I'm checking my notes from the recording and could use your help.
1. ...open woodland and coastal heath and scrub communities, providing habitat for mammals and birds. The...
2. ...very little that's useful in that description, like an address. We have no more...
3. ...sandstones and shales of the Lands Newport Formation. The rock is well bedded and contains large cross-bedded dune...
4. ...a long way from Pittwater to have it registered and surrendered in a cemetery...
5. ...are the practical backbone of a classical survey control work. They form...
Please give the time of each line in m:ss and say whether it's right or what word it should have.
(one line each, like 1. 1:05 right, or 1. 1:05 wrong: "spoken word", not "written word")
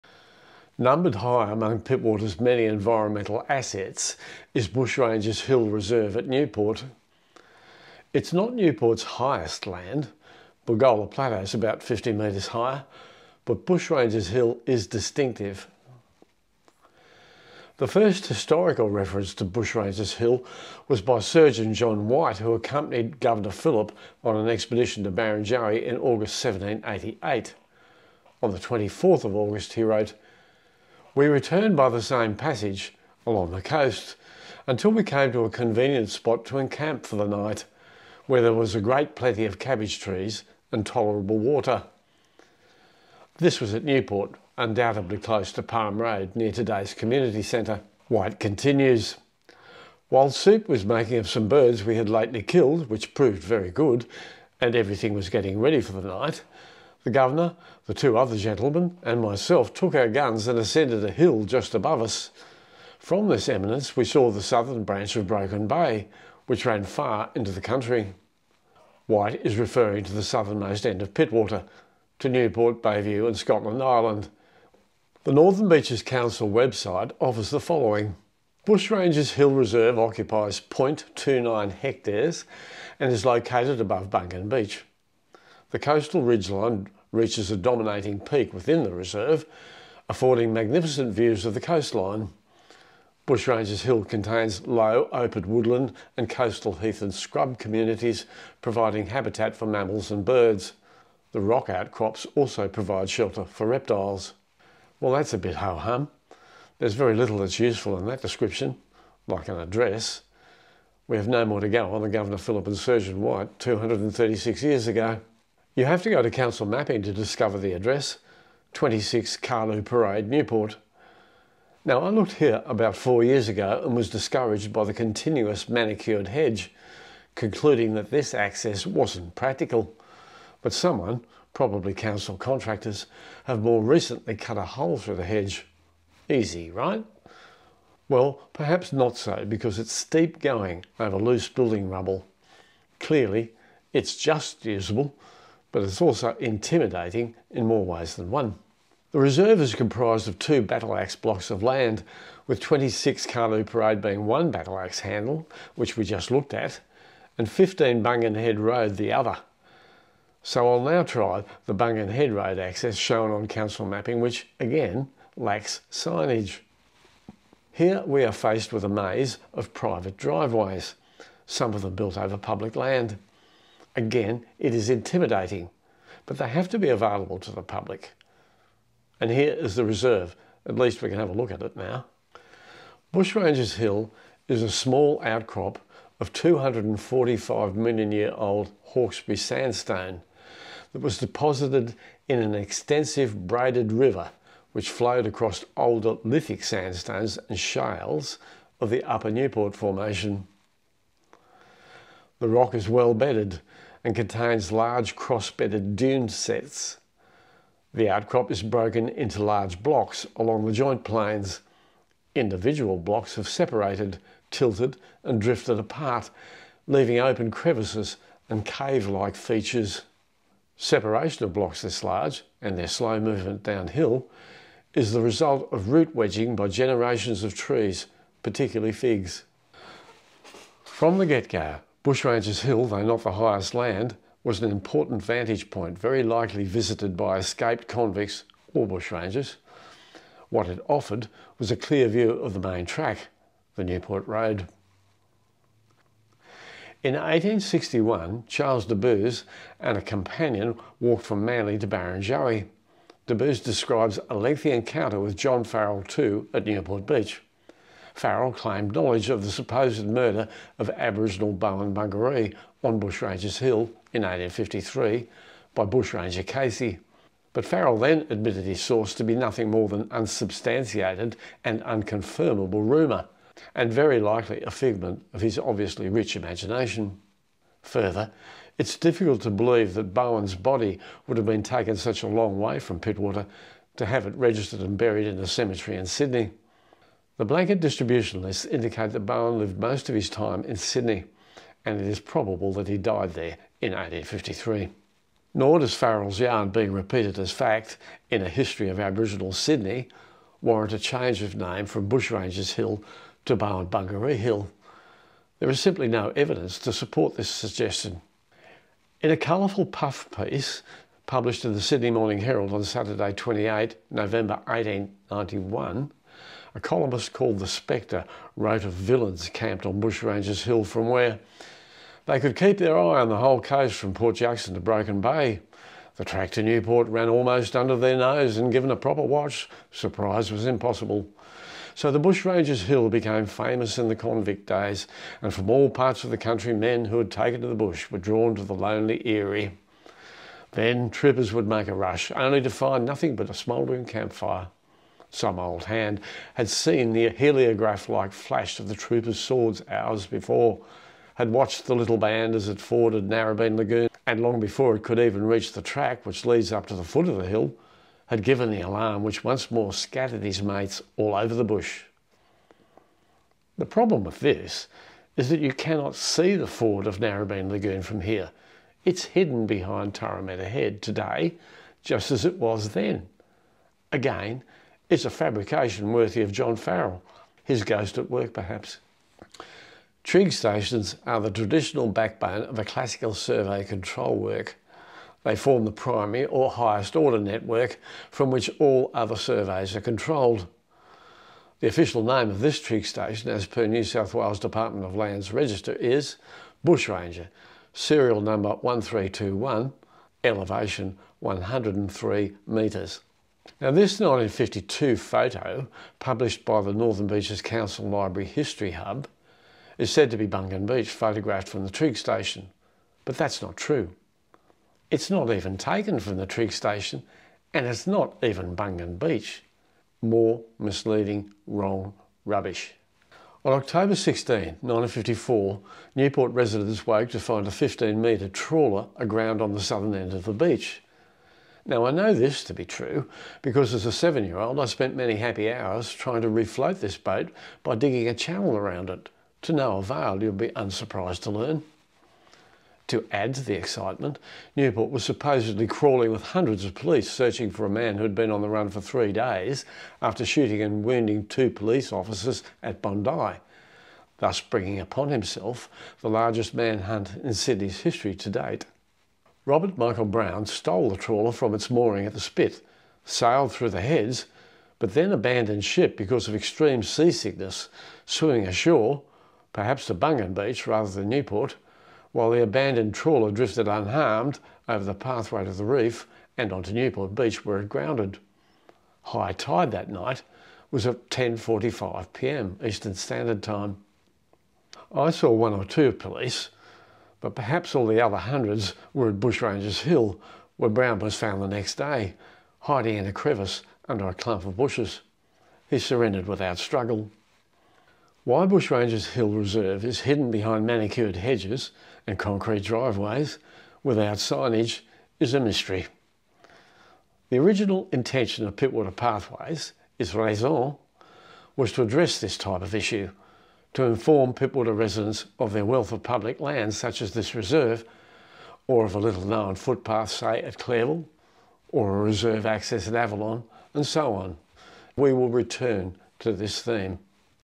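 1. 1:35 right
2. 1:46 right
3. 3:16 wrong: "Upper", not "Lands"
4. 4:42 wrong: "buried", not "surrendered"
5. 6:21 wrong: "traditional", not "practical".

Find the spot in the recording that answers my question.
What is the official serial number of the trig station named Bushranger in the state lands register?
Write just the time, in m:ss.
6:37.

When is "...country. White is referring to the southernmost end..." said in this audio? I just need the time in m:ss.
1:07.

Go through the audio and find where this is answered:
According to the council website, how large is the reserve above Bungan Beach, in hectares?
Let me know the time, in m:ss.
1:20.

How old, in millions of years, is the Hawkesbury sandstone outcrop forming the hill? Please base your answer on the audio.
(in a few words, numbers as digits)
245 million years.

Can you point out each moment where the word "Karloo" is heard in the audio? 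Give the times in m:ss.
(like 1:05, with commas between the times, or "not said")
1:59, 2:33.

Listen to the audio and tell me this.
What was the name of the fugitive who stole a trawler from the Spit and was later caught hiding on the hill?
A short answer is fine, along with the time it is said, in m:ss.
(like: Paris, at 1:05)
Robert Michael Brown, at 7:39.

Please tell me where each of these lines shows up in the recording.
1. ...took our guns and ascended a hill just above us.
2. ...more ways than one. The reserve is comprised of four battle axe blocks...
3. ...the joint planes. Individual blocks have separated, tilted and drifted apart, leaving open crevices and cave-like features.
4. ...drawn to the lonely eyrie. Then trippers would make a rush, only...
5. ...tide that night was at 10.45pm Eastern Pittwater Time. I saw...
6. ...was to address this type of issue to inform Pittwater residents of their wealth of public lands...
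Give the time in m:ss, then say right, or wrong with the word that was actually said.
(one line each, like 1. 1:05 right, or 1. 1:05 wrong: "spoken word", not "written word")
1. 0:59 right
2. 2:27 wrong: "two", not "four"
3. 3:30 right
4. 5:38 right
5. 7:59 wrong: "Standard", not "Pittwater"
6. 8:31 right.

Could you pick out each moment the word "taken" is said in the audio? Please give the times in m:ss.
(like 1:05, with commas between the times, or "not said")
4:41, 5:37, 6:55.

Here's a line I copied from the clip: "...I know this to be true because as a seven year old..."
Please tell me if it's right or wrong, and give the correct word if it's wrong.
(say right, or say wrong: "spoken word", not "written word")
right.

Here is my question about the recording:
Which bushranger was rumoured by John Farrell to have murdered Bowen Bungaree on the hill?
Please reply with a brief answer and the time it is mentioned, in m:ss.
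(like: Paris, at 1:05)
Casey, at 4:25.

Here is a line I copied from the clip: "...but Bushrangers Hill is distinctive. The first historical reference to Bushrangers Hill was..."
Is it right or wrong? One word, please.
right.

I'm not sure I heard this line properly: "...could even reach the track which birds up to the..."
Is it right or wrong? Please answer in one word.
wrong.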